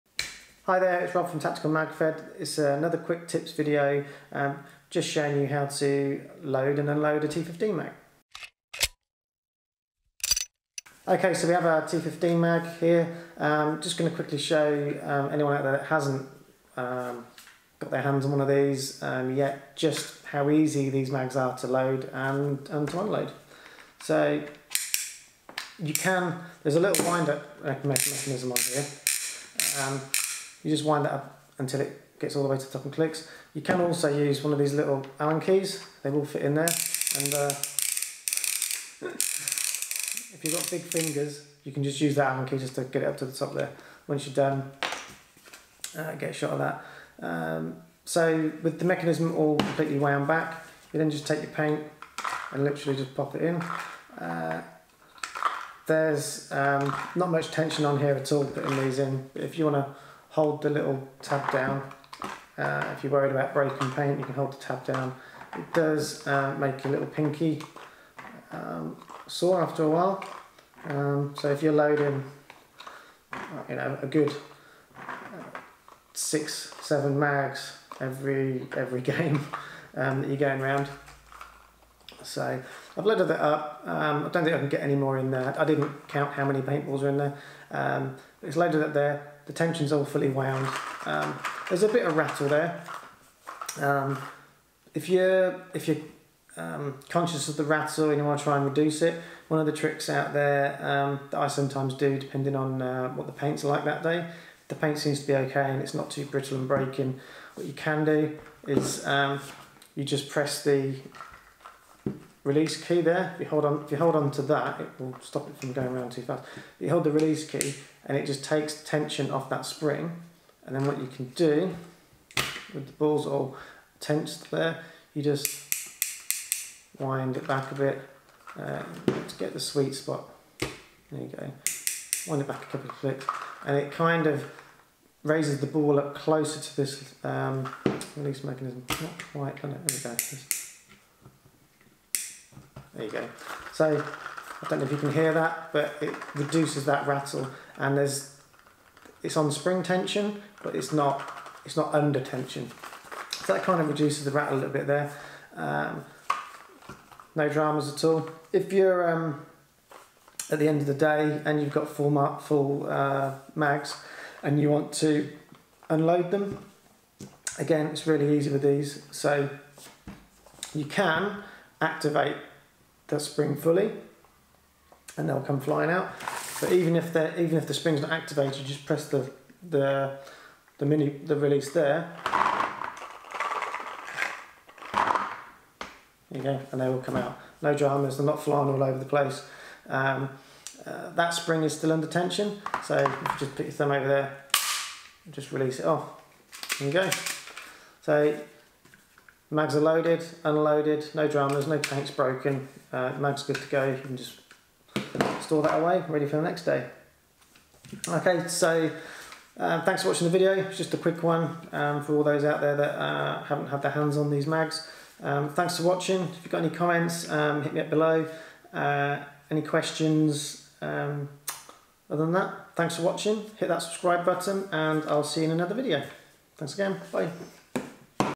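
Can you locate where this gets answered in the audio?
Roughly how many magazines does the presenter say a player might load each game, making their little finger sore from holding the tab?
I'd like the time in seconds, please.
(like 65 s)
76 s.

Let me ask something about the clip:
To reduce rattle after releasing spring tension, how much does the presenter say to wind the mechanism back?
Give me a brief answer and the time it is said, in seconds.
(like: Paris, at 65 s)
A couple of clicks, at 132 s.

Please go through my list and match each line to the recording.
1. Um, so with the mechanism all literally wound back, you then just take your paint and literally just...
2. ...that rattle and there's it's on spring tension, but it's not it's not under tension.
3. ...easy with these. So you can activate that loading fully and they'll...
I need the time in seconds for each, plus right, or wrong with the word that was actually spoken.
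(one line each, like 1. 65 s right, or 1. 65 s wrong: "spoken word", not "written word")
1. 47 s wrong: "completely", not "literally"
2. 146 s right
3. 168 s wrong: "spring", not "loading".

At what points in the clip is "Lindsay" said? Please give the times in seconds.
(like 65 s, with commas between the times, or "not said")
not said.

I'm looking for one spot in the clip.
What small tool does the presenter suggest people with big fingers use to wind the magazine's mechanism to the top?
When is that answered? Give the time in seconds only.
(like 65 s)
35 s.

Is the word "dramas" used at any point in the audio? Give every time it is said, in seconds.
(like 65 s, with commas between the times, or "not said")
157 s, 187 s, 201 s.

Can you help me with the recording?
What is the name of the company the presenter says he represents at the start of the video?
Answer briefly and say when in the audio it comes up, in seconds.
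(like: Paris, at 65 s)
Tactical MagFed, at 1 s.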